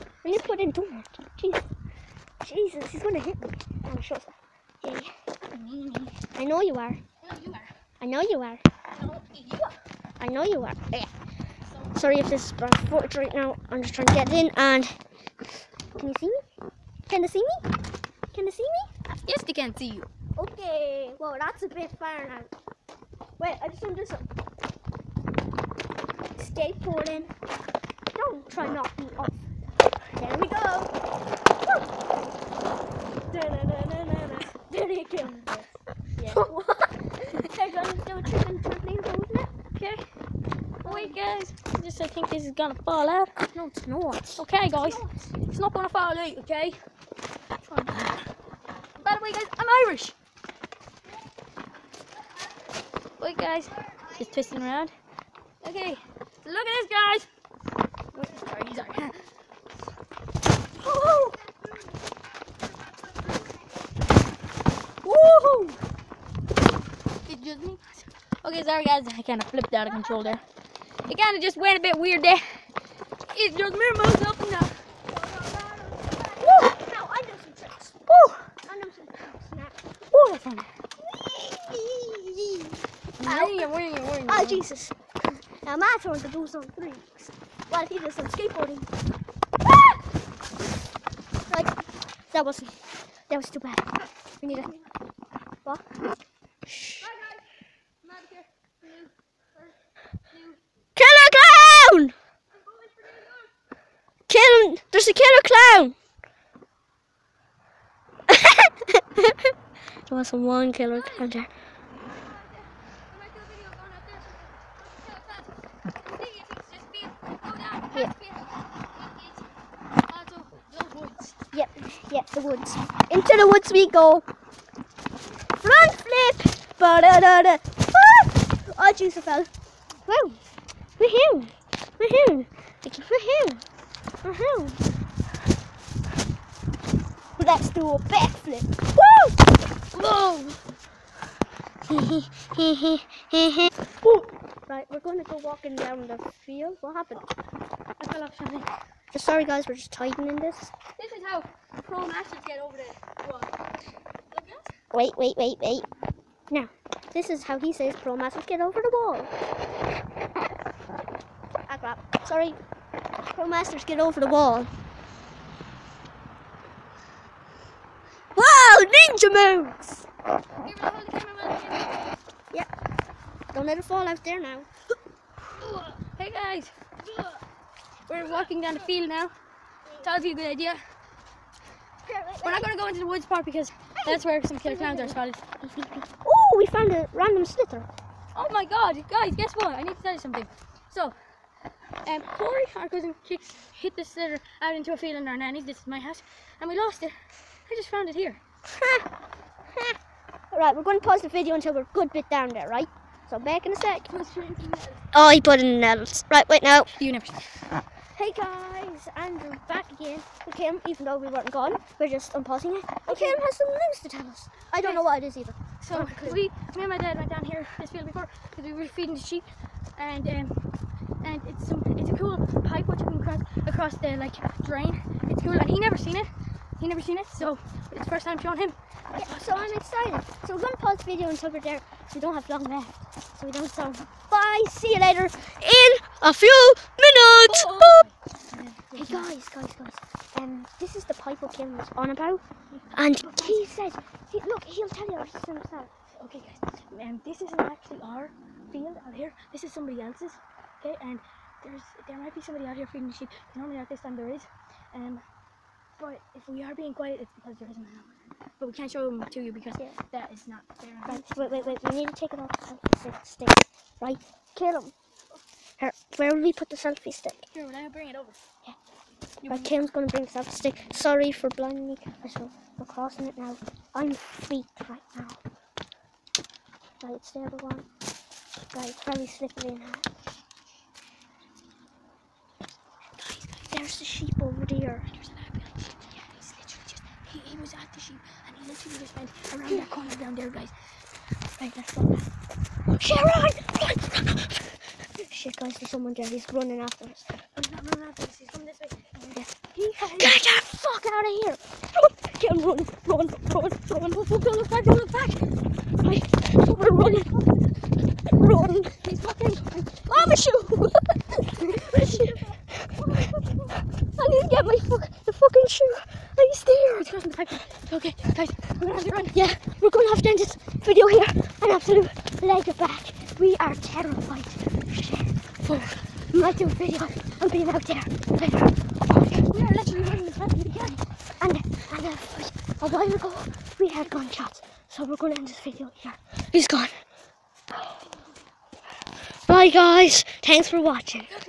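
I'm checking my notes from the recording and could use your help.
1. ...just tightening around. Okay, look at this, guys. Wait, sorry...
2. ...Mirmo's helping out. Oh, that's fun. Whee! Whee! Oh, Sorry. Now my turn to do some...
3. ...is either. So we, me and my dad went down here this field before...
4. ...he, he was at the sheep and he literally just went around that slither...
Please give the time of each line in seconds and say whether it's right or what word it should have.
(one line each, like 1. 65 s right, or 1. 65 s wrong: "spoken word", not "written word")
1. 54 s wrong: "twisting", not "tightening"
2. 73 s wrong: "Jesus", not "Sorry"
3. 215 s right
4. 287 s wrong: "corner", not "slither".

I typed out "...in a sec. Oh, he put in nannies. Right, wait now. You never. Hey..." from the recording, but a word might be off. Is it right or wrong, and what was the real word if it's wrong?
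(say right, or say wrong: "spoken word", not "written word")
wrong: "nettles", not "nannies".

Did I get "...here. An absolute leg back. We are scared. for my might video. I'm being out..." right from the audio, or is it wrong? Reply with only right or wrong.
wrong.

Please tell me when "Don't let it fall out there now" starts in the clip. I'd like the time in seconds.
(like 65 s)
173 s.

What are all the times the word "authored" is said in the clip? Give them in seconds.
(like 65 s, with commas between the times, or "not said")
not said.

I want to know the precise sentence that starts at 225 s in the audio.
It's cool, and he never seen it.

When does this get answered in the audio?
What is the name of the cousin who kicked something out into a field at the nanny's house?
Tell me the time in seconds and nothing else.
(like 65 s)
192 s.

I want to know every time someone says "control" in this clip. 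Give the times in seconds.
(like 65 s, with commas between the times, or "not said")
69 s.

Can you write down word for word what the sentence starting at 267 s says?
Here, when I bring it over.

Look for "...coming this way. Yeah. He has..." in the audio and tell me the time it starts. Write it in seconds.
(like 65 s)
298 s.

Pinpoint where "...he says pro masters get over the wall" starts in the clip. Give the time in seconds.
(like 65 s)
157 s.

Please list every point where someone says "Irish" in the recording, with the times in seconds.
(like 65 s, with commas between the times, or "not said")
49 s.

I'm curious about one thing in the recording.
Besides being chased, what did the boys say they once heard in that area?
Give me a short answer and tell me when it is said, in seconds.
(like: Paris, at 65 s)
Gunshots, at 334 s.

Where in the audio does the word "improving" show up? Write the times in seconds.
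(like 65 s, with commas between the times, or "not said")
not said.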